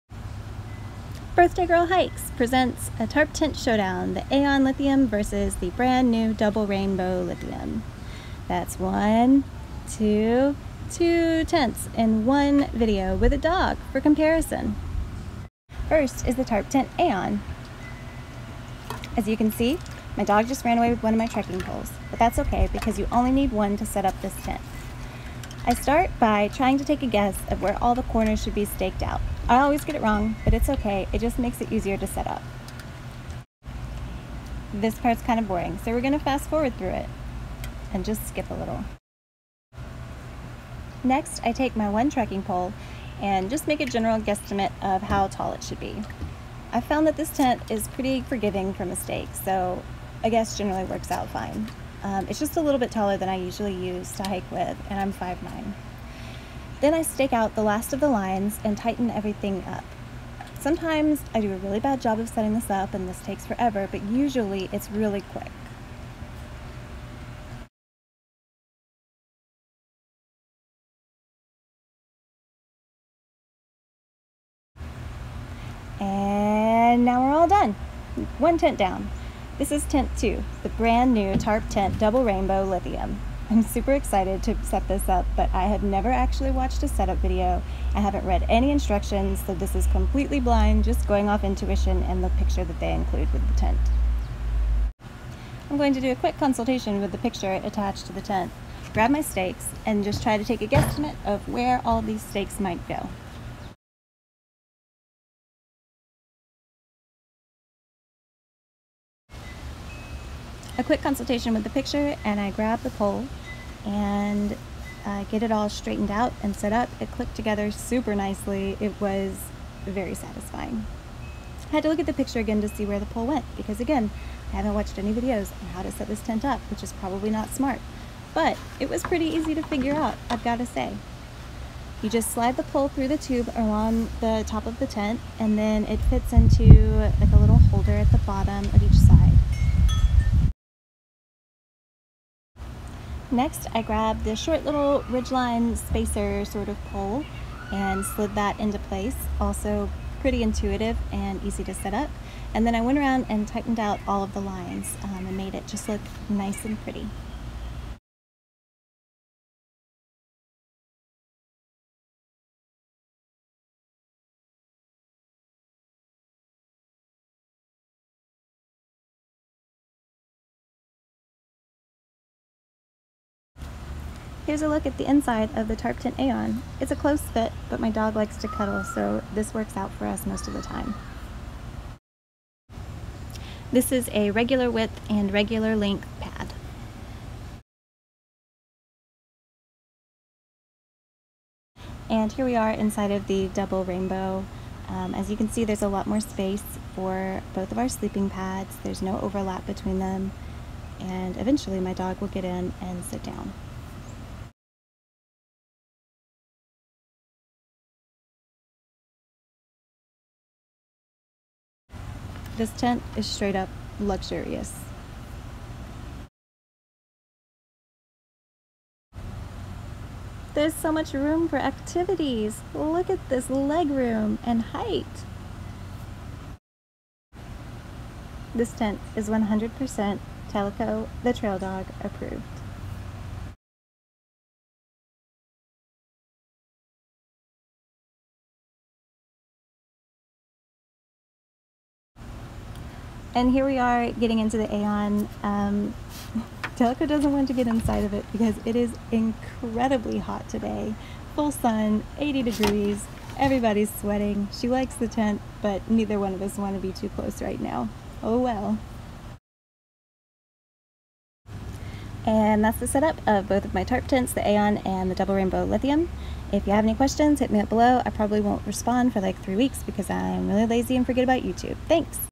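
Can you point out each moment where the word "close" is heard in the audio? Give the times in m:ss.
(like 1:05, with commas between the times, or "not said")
2:56, 4:17.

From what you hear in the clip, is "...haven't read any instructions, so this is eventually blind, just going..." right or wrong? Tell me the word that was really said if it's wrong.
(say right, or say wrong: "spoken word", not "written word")
wrong: "completely", not "eventually".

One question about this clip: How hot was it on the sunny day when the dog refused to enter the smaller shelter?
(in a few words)
80 degrees.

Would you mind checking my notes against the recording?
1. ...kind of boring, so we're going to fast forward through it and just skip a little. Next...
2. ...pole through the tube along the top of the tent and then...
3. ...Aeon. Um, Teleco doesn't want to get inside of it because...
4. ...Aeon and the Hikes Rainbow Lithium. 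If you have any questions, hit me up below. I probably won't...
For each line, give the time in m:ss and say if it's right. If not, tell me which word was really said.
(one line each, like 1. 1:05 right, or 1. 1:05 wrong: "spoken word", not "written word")
1. 0:35 right
2. 2:12 right
3. 4:04 wrong: "Delco", not "Teleco"
4. 4:24 wrong: "Double", not "Hikes".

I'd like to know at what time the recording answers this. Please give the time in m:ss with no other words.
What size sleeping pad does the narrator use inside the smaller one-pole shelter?
3:04.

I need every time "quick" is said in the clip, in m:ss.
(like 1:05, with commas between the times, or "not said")
1:05, 1:36, 1:50.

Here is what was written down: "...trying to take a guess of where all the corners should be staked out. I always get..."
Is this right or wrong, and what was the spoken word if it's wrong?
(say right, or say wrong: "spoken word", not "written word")
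right.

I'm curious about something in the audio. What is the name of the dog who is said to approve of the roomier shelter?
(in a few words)
Teleco.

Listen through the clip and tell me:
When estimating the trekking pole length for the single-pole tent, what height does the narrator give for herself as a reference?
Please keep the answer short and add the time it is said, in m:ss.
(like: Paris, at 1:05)
5'9", at 0:55.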